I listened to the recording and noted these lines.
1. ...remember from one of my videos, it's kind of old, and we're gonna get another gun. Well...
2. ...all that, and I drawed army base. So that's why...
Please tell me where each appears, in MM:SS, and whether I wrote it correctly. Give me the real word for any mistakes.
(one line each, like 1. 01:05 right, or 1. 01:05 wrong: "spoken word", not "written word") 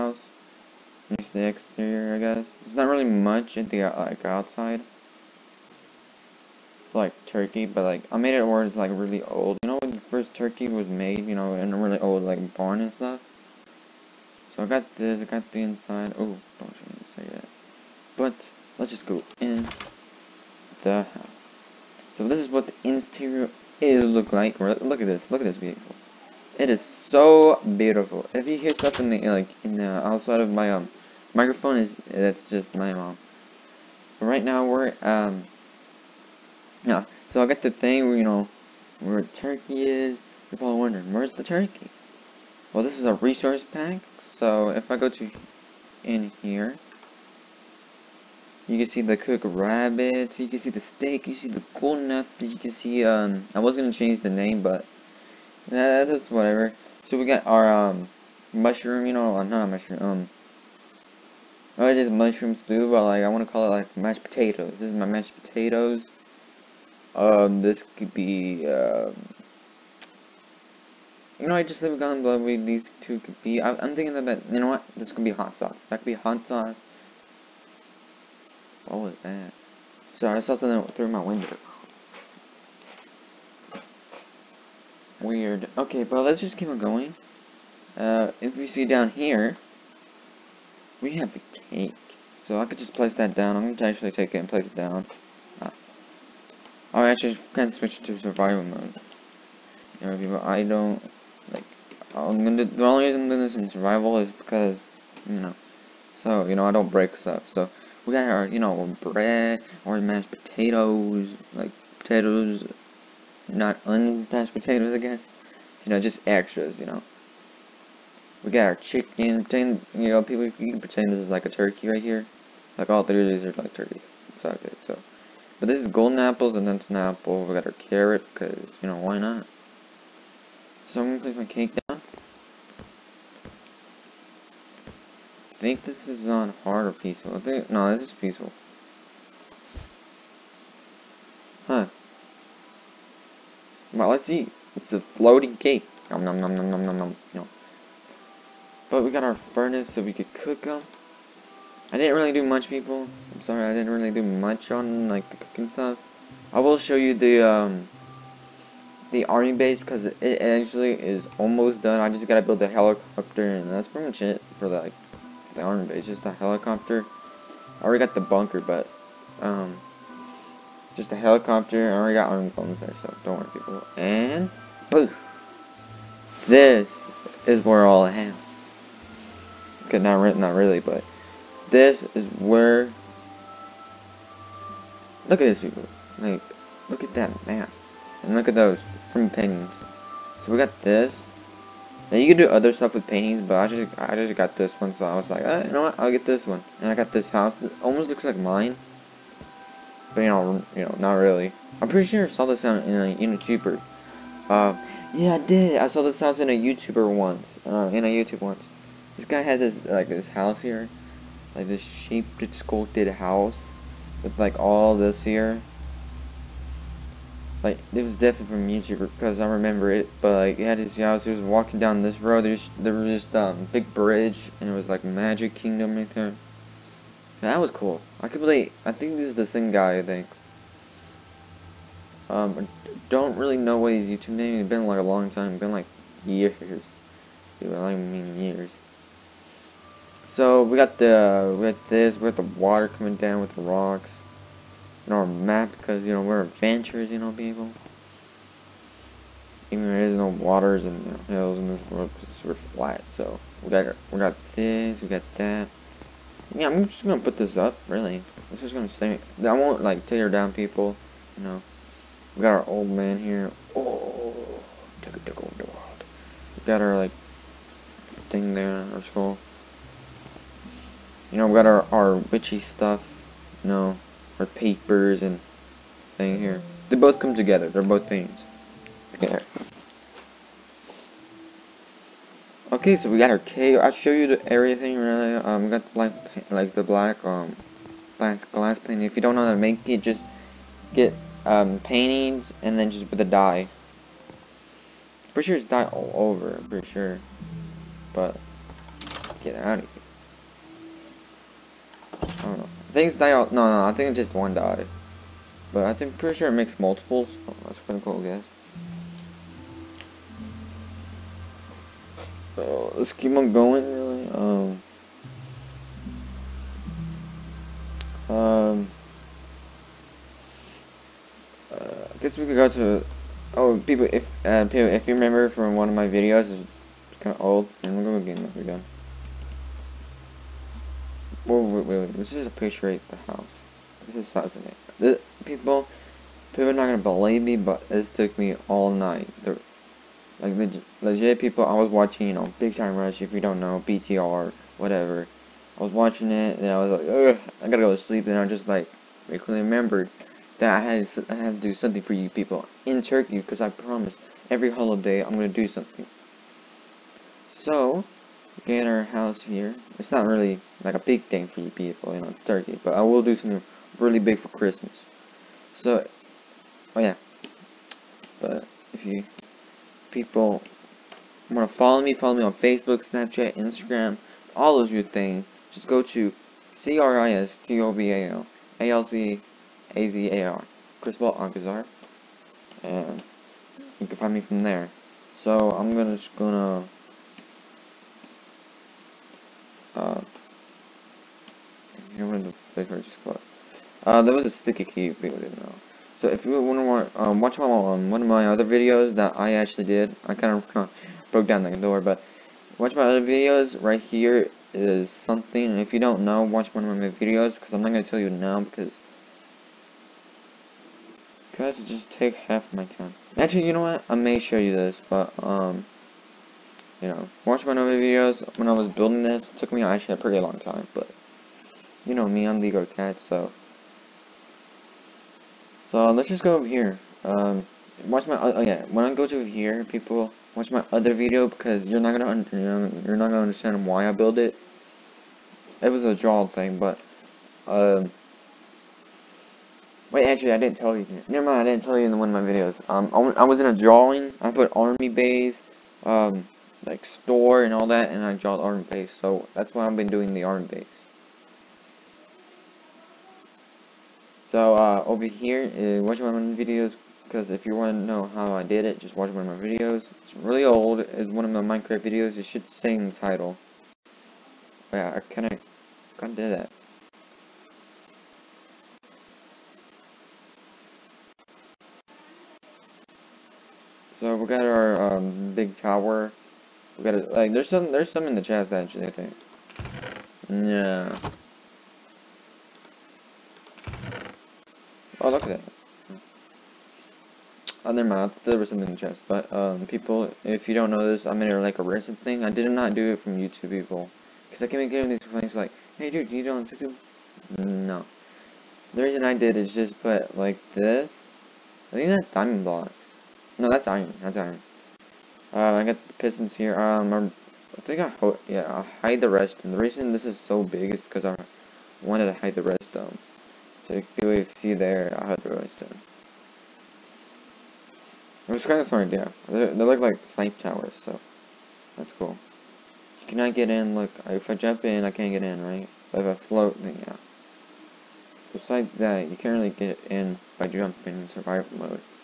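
1. 05:25 right
2. 07:27 right.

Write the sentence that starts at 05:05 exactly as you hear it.
But I think pretty sure it makes multiples.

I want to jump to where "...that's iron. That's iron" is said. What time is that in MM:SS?
08:23.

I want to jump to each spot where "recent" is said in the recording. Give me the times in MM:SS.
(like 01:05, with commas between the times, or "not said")
08:11.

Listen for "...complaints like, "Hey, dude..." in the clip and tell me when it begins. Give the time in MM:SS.
08:15.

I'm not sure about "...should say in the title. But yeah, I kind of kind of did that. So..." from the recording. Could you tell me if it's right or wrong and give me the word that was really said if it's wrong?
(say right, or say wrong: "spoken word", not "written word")
right.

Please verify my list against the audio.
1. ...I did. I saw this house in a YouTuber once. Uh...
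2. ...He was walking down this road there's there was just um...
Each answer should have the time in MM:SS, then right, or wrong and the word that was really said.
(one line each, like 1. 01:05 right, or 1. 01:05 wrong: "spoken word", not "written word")
1. 03:25 right
2. 03:41 right.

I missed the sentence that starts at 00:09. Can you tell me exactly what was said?
You know when the first turkey was made, you know, in a really old like barn and stuff.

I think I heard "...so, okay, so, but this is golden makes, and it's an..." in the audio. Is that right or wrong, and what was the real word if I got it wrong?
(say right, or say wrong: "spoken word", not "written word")
wrong: "apples", not "makes".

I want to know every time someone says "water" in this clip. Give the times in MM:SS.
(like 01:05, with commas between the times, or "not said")
04:02, 04:10.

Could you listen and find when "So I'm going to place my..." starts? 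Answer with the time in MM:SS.
02:10.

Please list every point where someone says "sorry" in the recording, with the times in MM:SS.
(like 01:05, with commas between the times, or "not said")
01:20, 02:33.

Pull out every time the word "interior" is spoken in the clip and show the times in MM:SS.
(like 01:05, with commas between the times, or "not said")
00:22.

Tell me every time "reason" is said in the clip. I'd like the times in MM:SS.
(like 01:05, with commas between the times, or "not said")
01:43, 08:19, 08:29.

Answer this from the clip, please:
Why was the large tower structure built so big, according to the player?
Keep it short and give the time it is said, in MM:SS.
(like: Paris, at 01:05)
to hide the redstone, at 08:32.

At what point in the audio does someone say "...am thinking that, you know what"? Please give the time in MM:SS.
01:13.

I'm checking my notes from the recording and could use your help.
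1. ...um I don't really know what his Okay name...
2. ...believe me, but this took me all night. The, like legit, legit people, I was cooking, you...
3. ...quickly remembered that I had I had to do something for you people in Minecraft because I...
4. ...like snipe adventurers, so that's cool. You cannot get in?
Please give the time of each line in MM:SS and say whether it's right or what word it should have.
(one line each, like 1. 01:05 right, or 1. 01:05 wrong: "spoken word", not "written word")
1. 03:52 wrong: "YouTube", not "Okay"
2. 05:36 wrong: "watching", not "cooking"
3. 05:49 wrong: "Turkey", not "Minecraft"
4. 08:40 wrong: "towers", not "adventurers".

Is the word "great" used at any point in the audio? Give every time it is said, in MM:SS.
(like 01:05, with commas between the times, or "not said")
not said.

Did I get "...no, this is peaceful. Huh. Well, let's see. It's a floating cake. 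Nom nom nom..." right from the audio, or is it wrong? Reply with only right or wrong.
right.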